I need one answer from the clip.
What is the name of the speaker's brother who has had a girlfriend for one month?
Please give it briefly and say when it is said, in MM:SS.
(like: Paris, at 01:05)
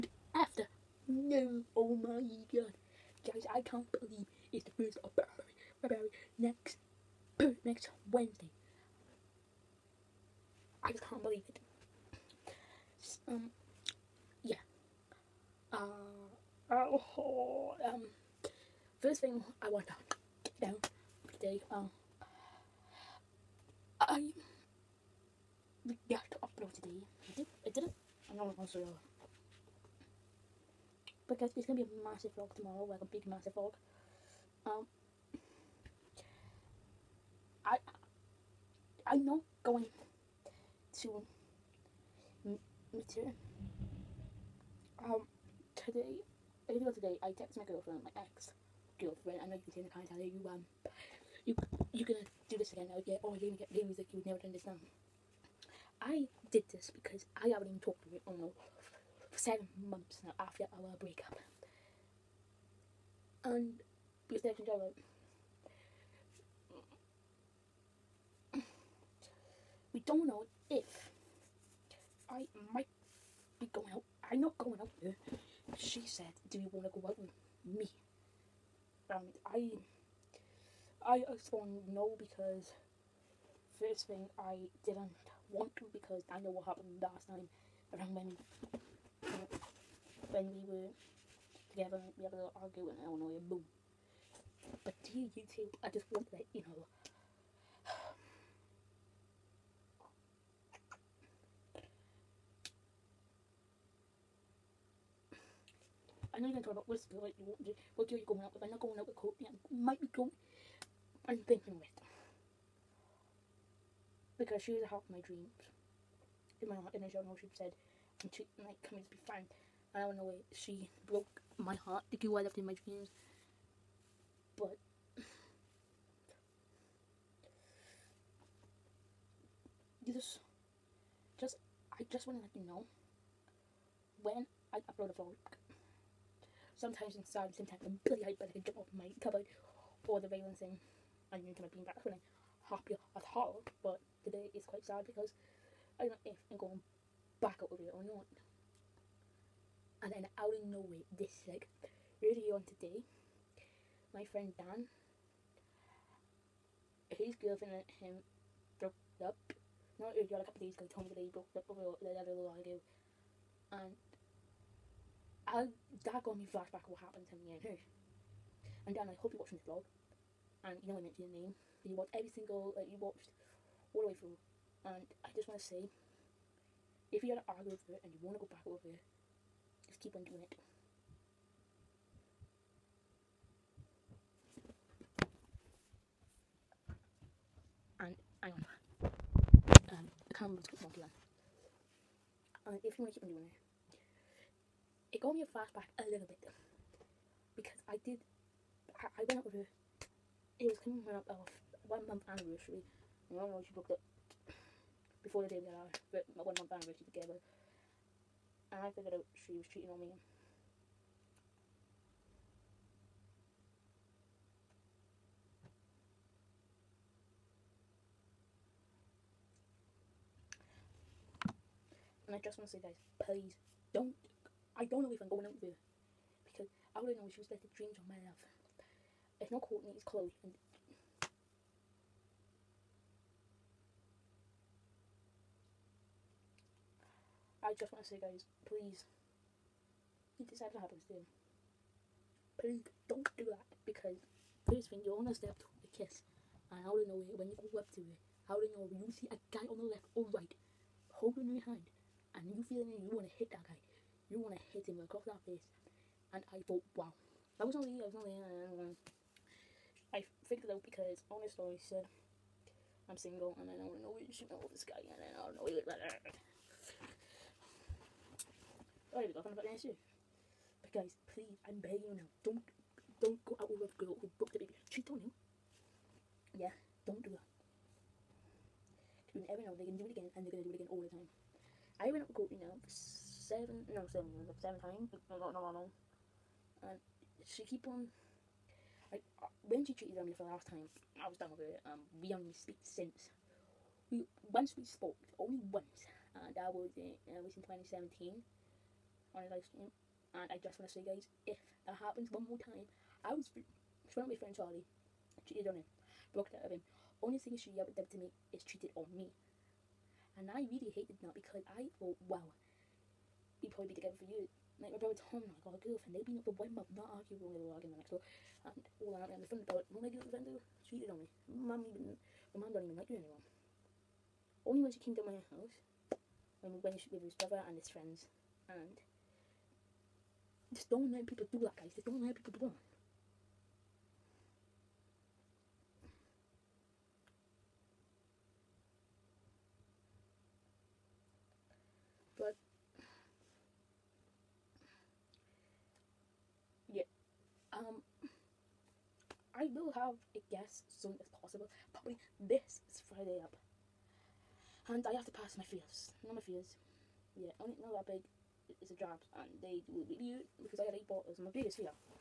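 Tom, at 05:15.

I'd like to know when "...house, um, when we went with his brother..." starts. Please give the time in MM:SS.
05:25.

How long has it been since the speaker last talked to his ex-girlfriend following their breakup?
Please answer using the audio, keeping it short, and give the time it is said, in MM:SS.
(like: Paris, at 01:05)
7 months, at 00:59.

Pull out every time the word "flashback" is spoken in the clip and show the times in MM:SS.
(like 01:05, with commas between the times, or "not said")
02:46, 03:15.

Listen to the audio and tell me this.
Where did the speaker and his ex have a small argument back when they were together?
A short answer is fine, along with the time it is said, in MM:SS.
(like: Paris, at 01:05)
Illinois, at 01:33.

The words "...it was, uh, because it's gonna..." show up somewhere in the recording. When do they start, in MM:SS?
00:28.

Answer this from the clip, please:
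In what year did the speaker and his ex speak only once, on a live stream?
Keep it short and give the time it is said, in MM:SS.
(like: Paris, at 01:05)
2017, at 04:57.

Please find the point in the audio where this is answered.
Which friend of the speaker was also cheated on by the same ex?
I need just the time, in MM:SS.
05:04.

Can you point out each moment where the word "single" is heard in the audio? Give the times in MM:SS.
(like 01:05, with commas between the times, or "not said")
02:52, 04:23.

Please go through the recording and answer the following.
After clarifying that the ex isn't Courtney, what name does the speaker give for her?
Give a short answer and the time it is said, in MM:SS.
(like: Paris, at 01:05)
Chloe, at 03:50.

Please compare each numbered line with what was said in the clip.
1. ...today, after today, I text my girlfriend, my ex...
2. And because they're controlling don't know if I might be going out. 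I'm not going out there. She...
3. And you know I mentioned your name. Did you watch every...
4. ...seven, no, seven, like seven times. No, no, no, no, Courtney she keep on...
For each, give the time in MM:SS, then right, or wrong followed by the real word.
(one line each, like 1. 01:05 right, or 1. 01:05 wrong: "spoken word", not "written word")
1. 00:45 wrong: "earlier", not "after"
2. 01:03 right
3. 02:50 right
4. 04:42 wrong: "And", not "Courtney".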